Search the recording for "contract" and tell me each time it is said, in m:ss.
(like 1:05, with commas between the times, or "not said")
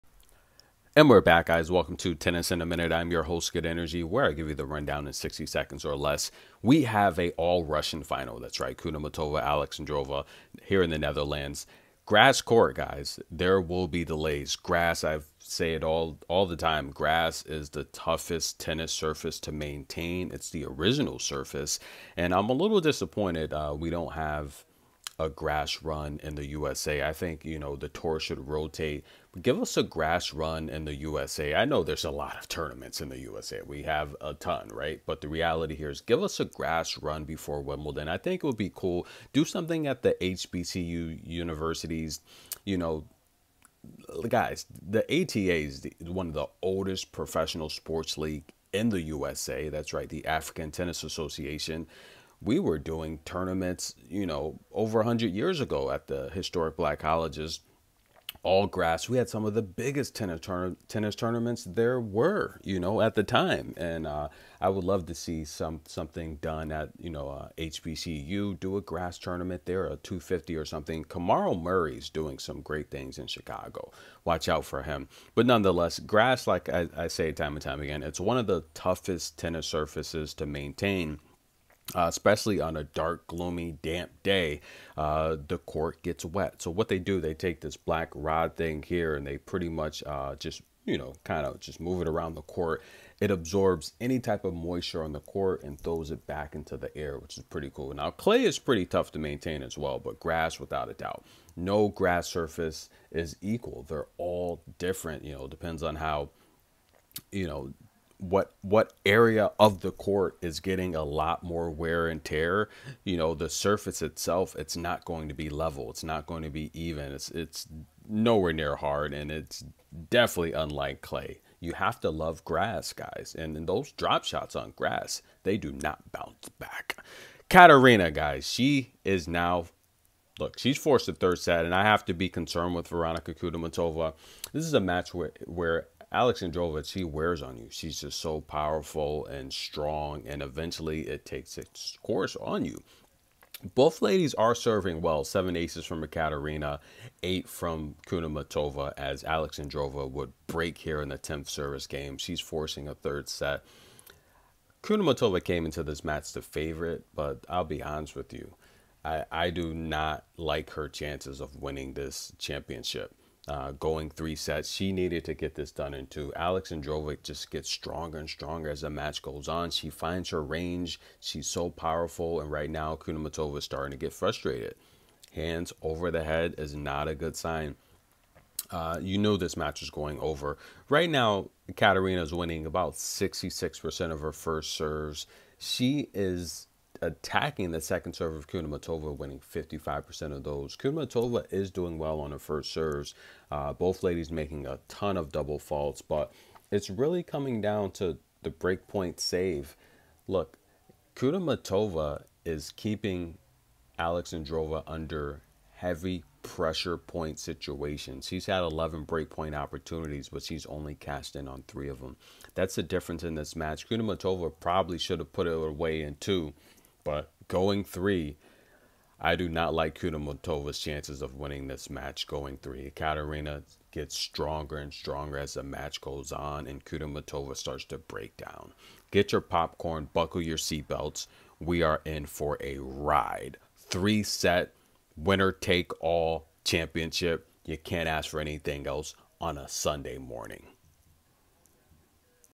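not said.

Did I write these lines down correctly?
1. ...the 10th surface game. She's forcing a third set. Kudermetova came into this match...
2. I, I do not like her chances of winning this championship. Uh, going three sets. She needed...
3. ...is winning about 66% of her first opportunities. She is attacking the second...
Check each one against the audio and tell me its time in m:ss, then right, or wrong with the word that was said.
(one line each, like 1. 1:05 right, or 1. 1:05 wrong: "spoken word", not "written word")
1. 2:31 wrong: "service", not "surface"
2. 2:39 right
3. 3:02 wrong: "serves", not "opportunities".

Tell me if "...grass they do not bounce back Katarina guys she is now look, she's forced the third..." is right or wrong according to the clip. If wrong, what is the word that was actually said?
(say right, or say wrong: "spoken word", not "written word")
right.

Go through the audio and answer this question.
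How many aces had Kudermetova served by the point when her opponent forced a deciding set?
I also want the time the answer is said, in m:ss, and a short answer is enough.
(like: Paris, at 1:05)
8, at 2:27.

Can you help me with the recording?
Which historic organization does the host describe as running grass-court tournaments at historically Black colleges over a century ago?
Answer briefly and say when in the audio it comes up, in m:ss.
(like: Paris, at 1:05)
African Tennis Association, at 0:50.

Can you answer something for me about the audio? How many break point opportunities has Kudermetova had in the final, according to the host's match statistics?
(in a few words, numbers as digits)
11.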